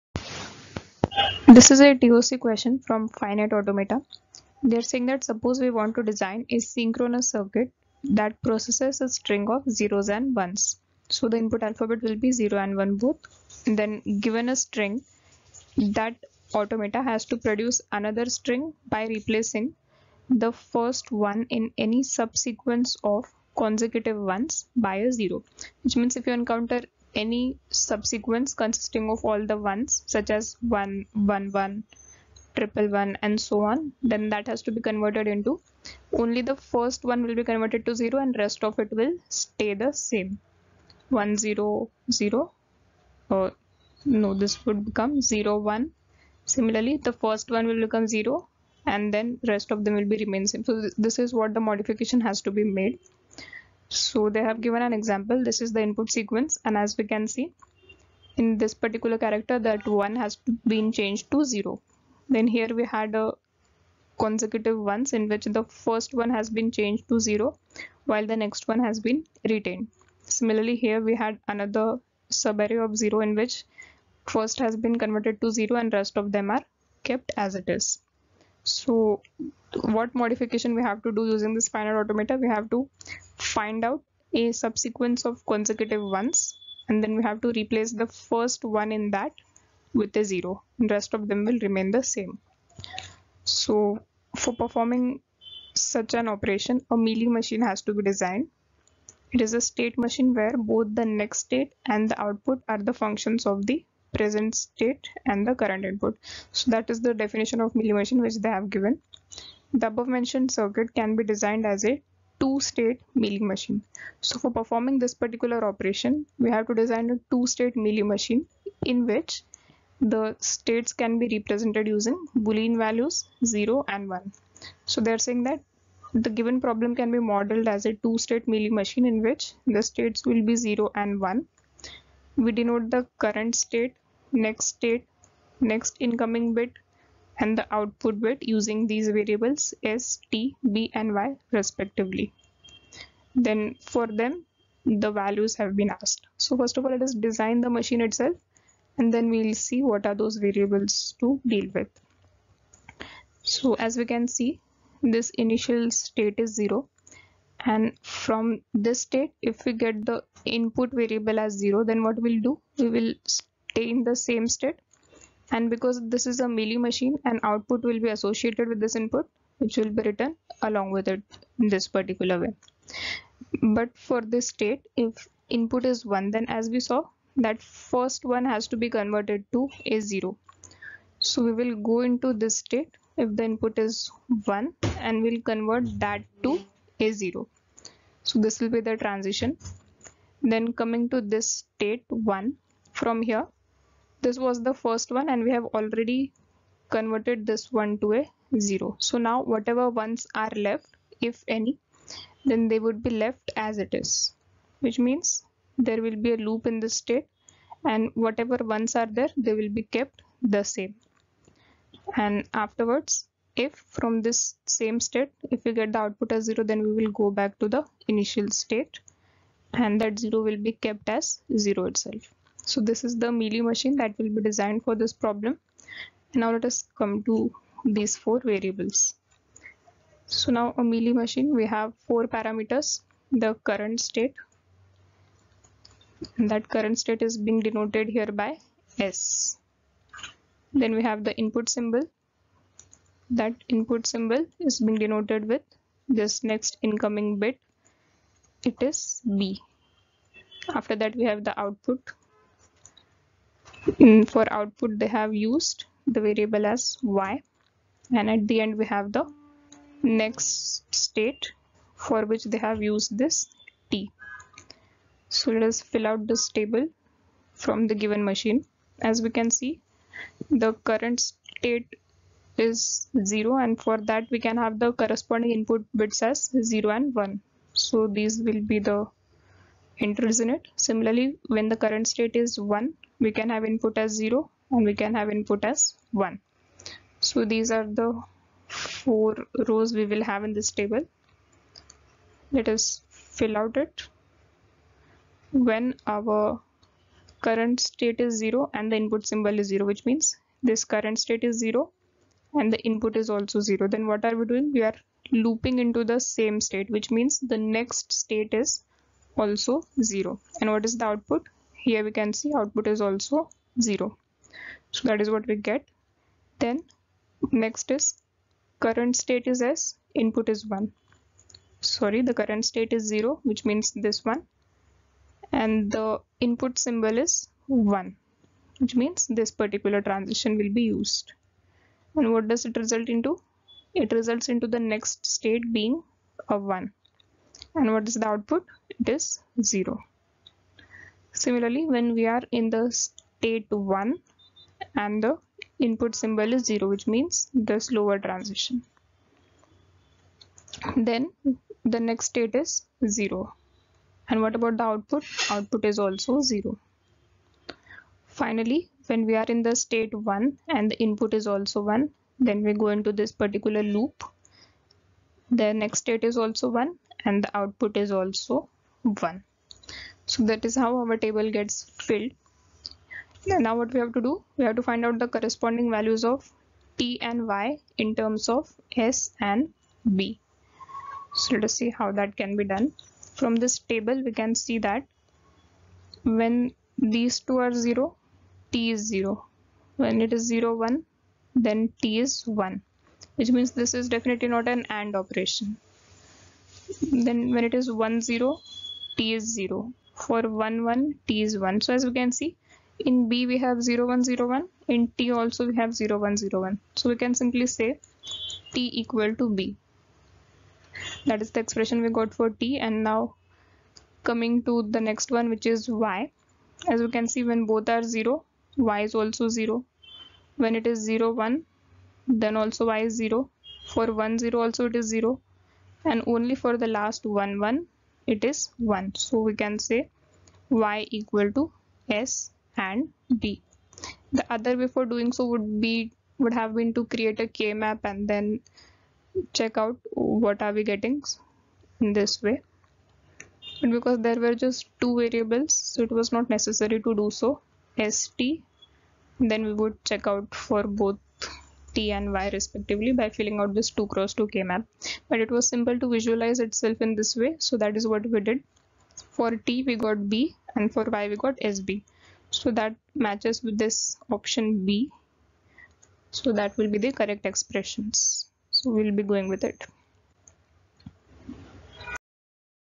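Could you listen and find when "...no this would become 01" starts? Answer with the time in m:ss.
0:44.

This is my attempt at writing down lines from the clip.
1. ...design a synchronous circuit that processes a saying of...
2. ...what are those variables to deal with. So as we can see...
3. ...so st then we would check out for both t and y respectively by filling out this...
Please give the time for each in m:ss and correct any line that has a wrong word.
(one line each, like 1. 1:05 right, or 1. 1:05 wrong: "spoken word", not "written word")
1. 0:06 wrong: "string", not "saying"
2. 2:29 right
3. 7:27 right.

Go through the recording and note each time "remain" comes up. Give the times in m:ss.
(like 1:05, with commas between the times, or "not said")
0:50, 1:31.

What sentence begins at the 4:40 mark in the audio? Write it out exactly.
Similarly, when the current state is 1, we can have input as 0 and we can have input as 1.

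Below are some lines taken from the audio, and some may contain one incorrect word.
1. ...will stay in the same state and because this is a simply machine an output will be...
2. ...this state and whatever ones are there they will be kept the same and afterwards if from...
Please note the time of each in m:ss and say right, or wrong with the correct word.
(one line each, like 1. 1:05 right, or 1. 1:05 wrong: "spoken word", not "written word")
1. 2:42 wrong: "mealy", not "simply"
2. 3:26 right.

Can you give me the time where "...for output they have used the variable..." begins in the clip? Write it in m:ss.
4:14.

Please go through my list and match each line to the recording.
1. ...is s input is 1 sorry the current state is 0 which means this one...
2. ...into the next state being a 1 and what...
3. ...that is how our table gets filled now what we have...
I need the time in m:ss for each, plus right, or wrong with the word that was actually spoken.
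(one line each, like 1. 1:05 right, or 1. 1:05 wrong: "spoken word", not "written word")
1. 5:19 right
2. 5:34 right
3. 6:10 right.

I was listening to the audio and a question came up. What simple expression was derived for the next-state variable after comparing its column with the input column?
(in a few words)
t = b.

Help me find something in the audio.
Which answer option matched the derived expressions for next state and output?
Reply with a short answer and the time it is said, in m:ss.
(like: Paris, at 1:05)
Option B, at 7:44.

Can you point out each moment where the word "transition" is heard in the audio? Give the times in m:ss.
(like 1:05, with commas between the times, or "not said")
3:09, 5:30, 5:48.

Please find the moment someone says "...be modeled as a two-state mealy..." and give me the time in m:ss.
2:07.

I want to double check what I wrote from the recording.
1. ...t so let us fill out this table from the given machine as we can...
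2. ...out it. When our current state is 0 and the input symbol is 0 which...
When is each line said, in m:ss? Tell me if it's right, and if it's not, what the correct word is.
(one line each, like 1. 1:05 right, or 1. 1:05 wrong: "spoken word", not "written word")
1. 4:23 right
2. 4:53 right.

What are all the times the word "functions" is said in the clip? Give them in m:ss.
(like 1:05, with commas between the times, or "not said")
1:42.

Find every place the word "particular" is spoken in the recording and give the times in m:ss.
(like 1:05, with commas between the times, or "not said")
0:58, 1:55, 2:51, 5:29, 6:03.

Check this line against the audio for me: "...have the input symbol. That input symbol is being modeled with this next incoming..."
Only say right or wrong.
wrong.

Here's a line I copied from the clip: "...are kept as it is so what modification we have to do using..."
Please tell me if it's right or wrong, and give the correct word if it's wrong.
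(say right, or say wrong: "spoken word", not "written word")
right.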